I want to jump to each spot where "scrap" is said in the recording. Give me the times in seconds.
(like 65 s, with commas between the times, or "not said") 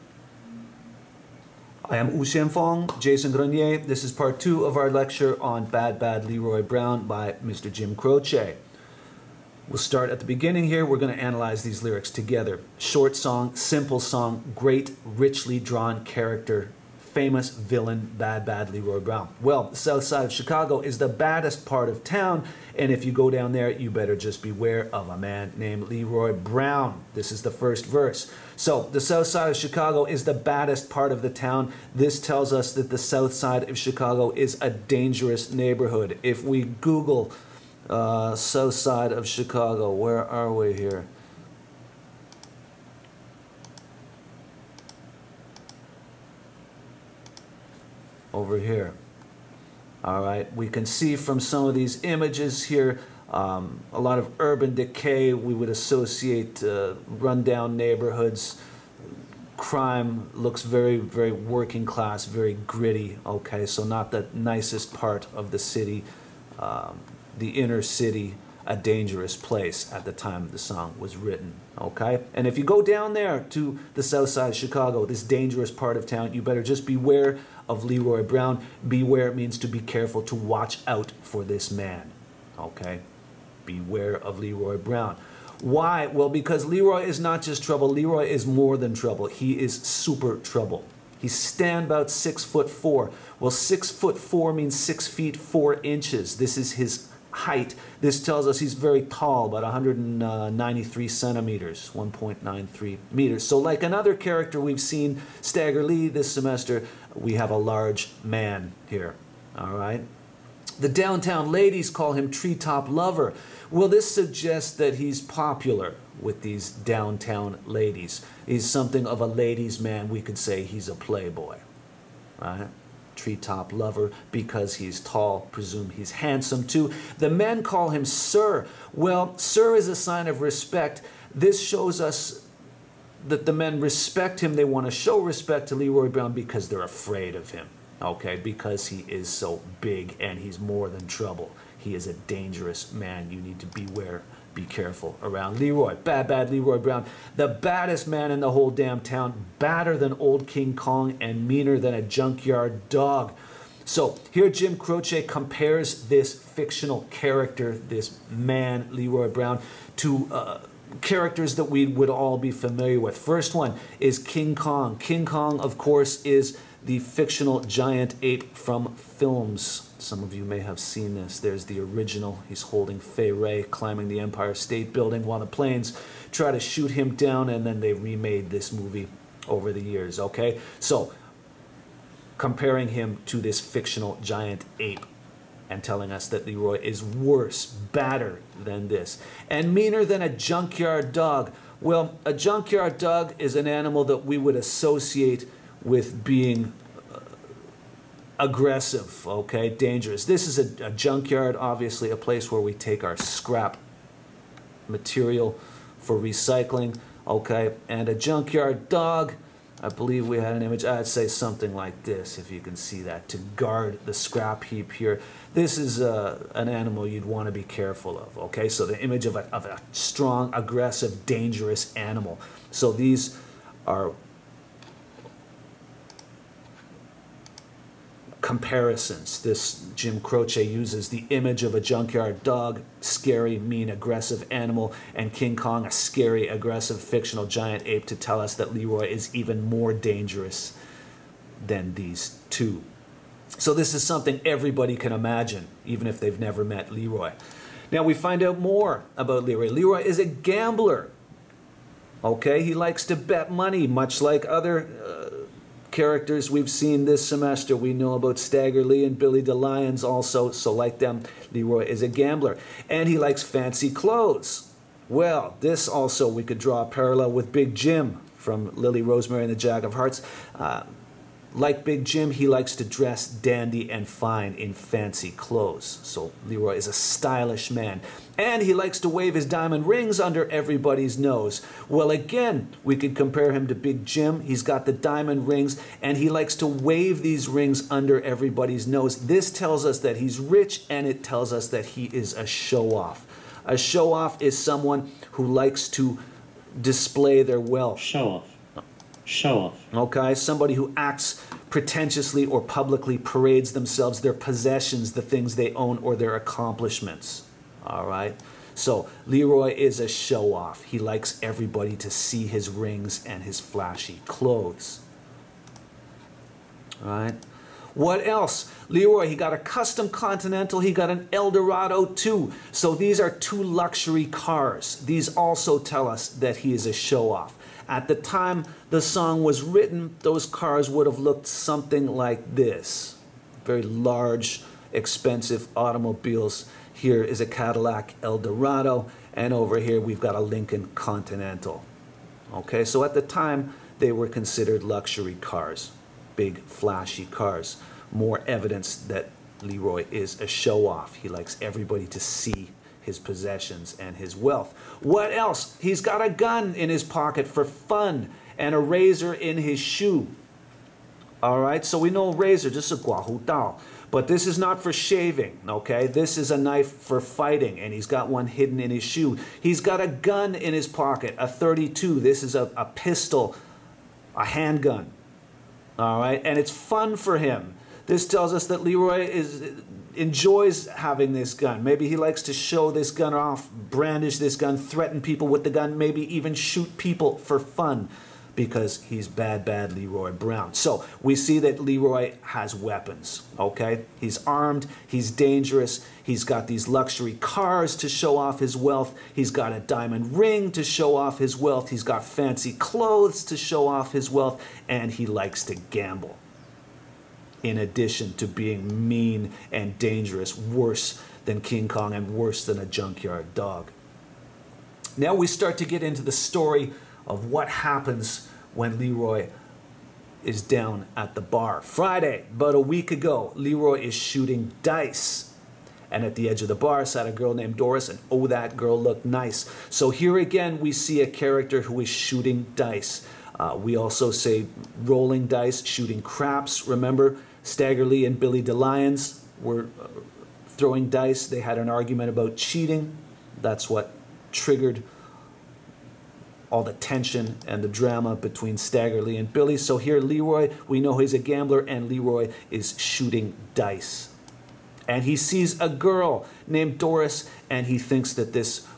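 203 s, 214 s.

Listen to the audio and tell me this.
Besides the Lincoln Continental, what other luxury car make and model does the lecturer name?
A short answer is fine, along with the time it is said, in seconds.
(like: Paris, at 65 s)
Cadillac Eldorado, at 337 s.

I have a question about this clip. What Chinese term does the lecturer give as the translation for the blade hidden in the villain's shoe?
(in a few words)
guahu dao.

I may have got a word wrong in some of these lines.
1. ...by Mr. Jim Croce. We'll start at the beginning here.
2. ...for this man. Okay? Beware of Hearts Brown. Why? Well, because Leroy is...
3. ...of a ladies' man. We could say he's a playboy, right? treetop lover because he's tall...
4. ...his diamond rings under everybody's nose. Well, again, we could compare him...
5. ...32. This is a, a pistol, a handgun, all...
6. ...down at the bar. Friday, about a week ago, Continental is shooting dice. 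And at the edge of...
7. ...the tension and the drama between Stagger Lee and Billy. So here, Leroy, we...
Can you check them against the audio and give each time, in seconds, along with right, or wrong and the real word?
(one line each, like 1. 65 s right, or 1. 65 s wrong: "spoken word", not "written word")
1. 7 s right
2. 81 s wrong: "Leroy", not "Hearts"
3. 119 s right
4. 279 s right
5. 371 s right
6. 420 s wrong: "Leroy", not "Continental"
7. 446 s right.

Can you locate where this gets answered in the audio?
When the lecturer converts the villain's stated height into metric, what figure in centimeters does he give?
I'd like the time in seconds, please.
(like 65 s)
99 s.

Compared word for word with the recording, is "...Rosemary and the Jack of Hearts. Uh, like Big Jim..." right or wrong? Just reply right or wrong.
right.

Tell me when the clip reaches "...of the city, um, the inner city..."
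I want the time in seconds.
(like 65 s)
65 s.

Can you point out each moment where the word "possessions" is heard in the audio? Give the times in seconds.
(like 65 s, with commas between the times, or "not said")
304 s, 353 s.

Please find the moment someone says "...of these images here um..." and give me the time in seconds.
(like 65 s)
51 s.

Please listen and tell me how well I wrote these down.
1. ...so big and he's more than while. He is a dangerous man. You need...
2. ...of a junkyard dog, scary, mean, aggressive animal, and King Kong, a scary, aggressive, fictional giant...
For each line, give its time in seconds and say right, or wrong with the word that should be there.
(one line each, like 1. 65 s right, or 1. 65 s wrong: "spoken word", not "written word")
1. 139 s wrong: "trouble", not "while"
2. 231 s right.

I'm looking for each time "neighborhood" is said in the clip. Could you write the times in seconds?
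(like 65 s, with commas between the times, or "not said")
35 s, 57 s.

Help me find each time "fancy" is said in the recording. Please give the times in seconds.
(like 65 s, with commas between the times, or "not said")
263 s, 274 s, 402 s.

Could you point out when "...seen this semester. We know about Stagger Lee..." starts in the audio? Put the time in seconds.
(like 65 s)
256 s.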